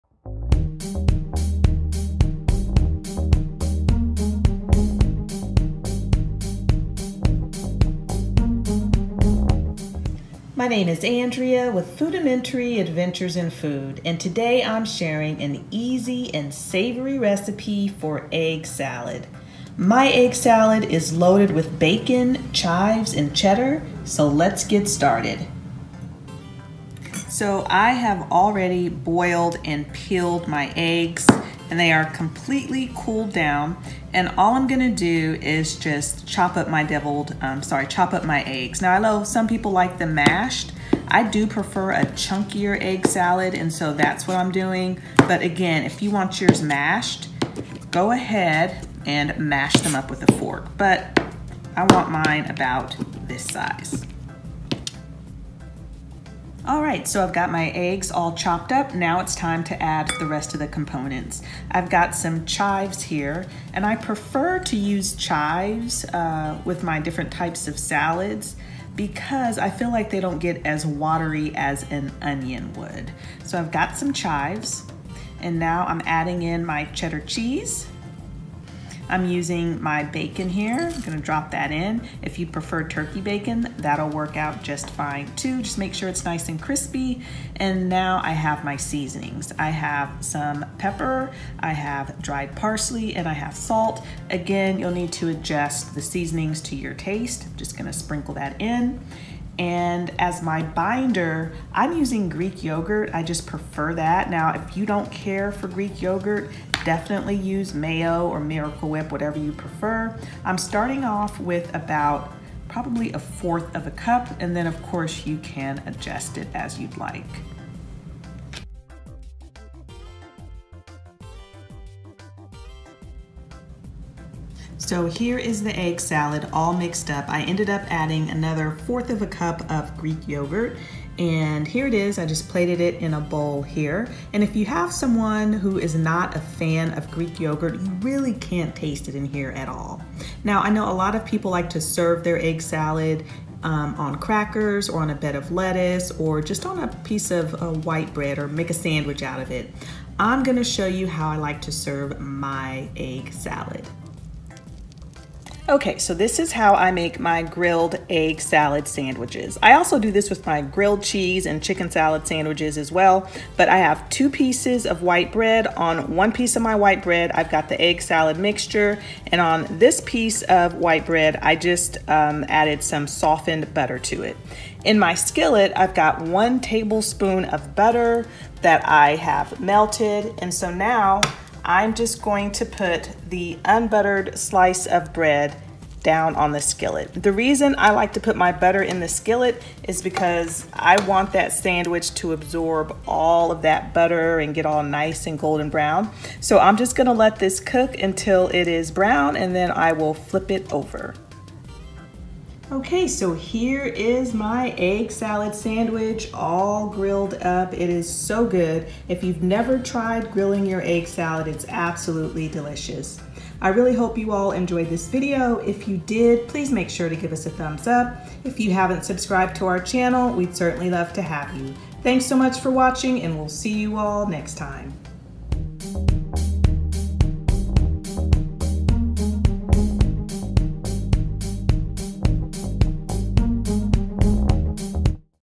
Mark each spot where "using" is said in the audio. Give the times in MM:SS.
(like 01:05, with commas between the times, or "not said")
01:19, 01:41.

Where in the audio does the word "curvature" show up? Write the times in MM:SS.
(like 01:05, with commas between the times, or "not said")
not said.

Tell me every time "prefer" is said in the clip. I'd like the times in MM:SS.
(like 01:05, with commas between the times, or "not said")
00:41, 01:03, 01:22, 01:43, 01:49.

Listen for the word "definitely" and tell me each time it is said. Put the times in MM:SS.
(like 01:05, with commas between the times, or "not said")
01:46.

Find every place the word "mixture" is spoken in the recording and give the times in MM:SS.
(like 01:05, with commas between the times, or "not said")
02:48.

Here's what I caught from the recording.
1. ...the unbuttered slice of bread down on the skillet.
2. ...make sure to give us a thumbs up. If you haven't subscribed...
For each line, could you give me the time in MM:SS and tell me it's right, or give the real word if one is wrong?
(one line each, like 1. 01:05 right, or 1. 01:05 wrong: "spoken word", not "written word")
1. 03:03 right
2. 03:36 right.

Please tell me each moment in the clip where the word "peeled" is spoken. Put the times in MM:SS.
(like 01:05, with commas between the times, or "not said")
00:29.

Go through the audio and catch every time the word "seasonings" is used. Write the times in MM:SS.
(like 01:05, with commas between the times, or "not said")
01:28, 01:36.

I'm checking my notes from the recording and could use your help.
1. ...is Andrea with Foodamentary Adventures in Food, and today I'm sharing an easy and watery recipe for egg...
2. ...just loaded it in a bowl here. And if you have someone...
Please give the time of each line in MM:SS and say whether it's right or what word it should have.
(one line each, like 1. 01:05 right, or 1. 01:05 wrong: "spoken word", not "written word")
1. 00:10 wrong: "savory", not "watery"
2. 02:12 wrong: "plated", not "loaded".